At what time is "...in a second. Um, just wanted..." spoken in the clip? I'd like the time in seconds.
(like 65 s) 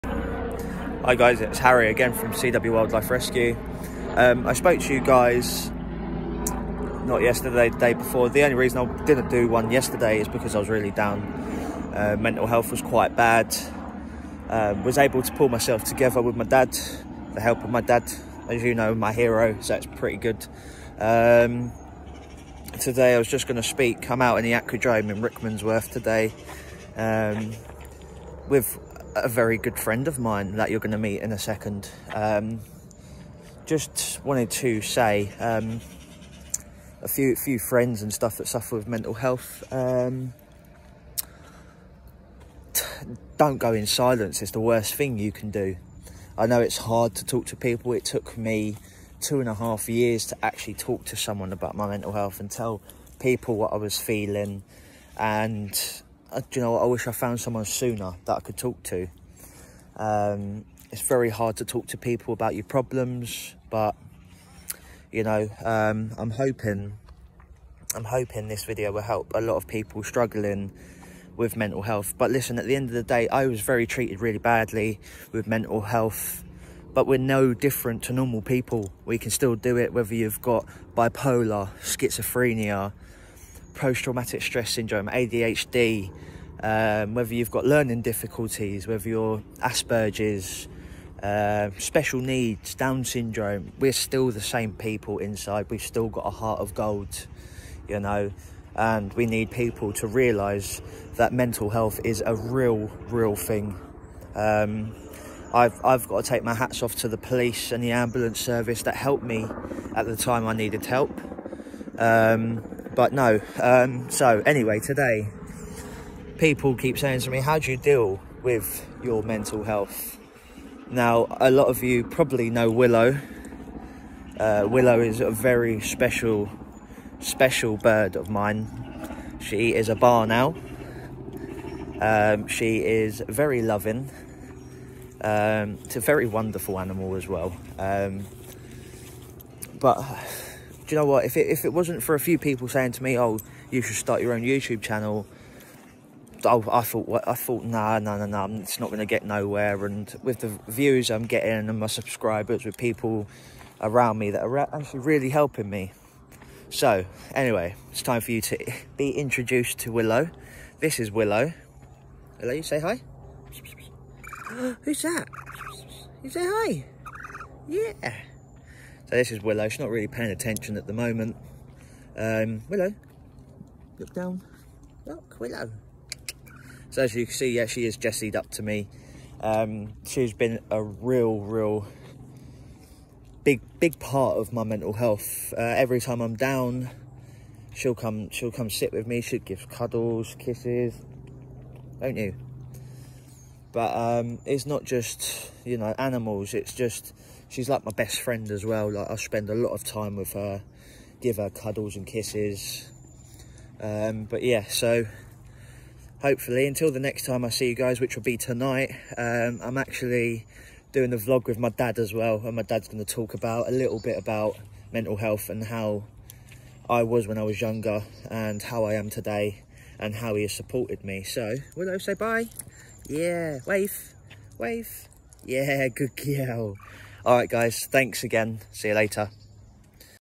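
31 s.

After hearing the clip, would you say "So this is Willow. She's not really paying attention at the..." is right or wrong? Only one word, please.
right.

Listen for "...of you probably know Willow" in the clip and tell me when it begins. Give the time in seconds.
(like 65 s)
121 s.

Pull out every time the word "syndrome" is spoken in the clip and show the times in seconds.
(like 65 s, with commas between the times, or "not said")
84 s, 93 s.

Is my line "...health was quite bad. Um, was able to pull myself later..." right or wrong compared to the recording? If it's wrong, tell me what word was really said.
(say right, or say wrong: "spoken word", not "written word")
wrong: "together", not "later".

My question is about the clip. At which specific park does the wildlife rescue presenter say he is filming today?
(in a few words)
Aquadrome in Rickmansworth.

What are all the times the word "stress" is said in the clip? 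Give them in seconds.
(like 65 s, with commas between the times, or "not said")
84 s.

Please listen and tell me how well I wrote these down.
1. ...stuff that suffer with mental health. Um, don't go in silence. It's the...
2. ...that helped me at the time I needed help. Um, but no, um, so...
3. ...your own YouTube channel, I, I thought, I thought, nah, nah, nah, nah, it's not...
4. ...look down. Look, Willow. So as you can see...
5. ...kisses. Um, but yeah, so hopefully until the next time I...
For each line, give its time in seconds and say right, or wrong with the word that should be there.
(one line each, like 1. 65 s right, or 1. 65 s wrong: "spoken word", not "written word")
1. 38 s right
2. 108 s right
3. 144 s right
4. 173 s right
5. 202 s right.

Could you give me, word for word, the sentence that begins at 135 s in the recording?
Um, it's a very wonderful animal as well.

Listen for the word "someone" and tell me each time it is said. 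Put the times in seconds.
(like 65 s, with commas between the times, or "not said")
51 s, 57 s.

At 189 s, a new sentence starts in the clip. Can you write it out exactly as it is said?
She'll give cuddles, kisses, don't you?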